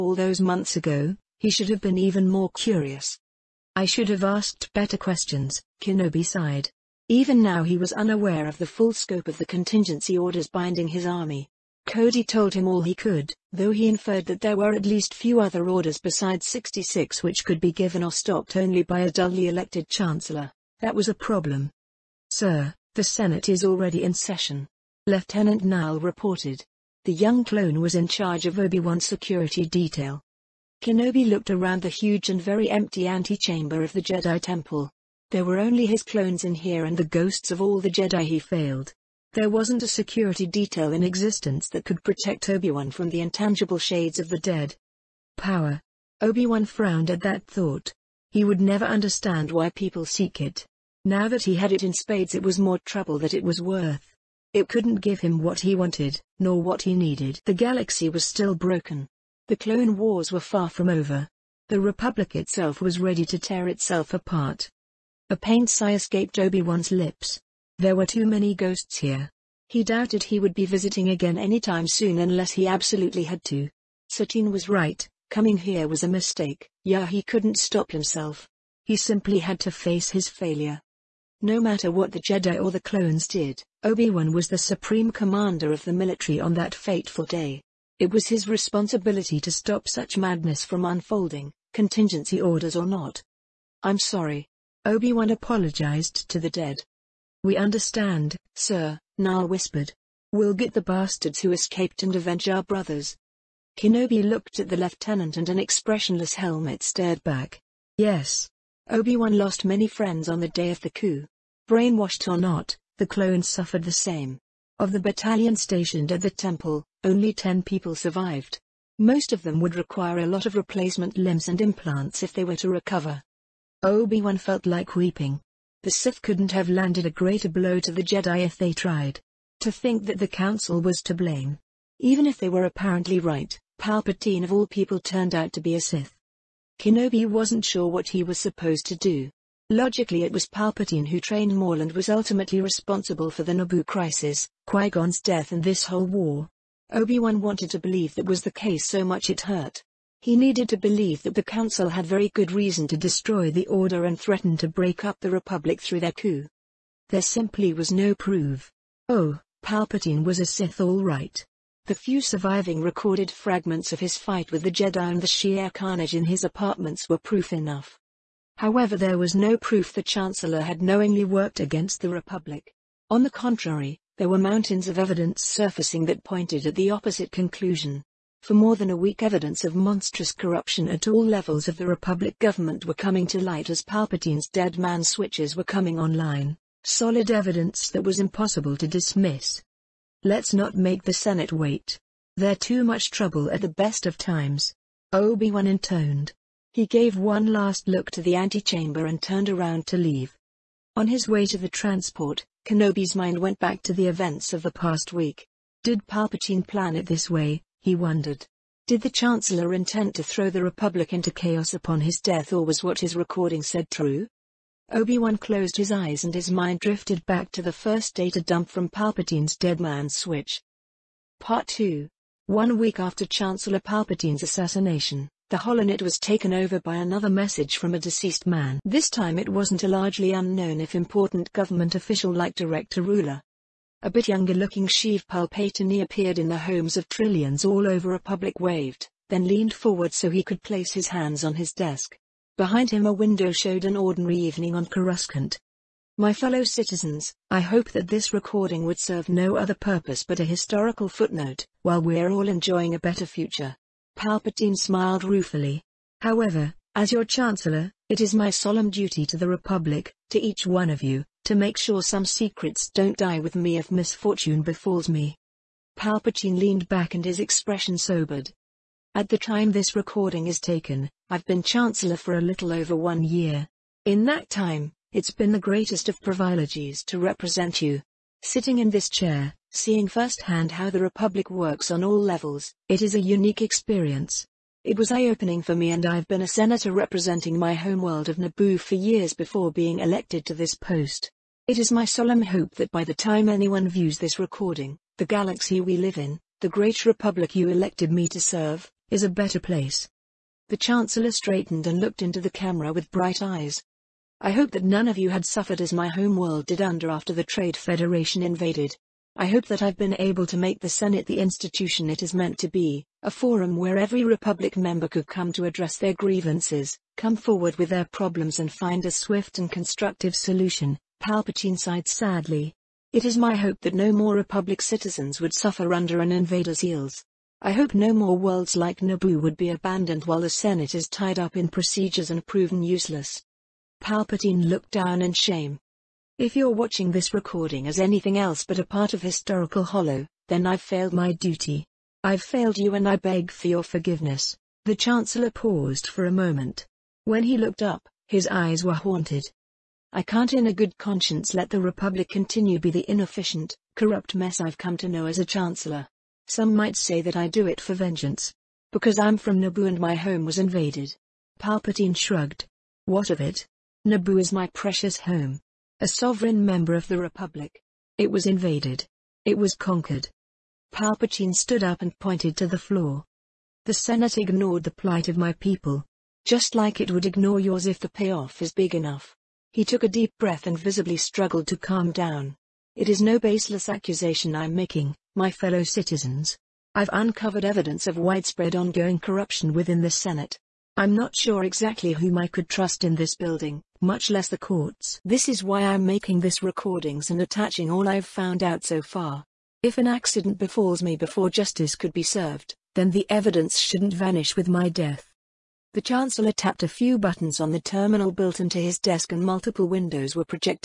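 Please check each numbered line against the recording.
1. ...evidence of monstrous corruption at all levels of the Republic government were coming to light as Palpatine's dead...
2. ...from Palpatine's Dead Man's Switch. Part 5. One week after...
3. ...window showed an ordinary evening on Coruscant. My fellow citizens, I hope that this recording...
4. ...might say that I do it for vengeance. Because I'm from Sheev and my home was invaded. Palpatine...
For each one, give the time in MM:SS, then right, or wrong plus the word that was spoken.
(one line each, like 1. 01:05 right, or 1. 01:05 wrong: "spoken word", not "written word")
1. 02:59 right
2. 03:38 wrong: "2", not "5"
3. 04:03 right
4. 05:56 wrong: "Naboo", not "Sheev".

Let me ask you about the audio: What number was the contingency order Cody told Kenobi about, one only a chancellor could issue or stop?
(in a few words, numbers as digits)
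66.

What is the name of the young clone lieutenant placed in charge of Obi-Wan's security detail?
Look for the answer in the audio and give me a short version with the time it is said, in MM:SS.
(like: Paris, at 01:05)
Niall, at 00:25.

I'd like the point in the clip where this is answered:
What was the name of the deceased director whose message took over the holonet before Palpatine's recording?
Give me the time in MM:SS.
03:52.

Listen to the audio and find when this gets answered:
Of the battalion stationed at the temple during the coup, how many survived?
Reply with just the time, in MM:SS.
01:57.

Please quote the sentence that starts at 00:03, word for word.
I should have asked better questions, Kenobi sighed.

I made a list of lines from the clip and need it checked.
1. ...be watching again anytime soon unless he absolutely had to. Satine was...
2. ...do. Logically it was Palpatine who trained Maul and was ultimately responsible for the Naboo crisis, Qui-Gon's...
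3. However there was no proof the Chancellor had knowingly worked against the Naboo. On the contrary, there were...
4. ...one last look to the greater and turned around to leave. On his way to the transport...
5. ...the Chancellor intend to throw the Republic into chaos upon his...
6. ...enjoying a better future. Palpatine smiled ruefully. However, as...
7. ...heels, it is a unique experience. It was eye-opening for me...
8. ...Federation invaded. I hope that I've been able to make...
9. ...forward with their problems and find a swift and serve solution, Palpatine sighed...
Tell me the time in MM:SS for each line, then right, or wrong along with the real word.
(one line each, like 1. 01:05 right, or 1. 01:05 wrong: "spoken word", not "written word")
1. 01:10 wrong: "visiting", not "watching"
2. 02:18 right
3. 02:48 wrong: "Republic", not "Naboo"
4. 03:17 wrong: "antechamber", not "greater"
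5. 03:29 right
6. 04:12 right
7. 04:42 wrong: "levels", not "heels"
8. 05:07 right
9. 05:17 wrong: "constructive", not "serve".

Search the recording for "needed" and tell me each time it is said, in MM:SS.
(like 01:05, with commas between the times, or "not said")
00:56, 02:30.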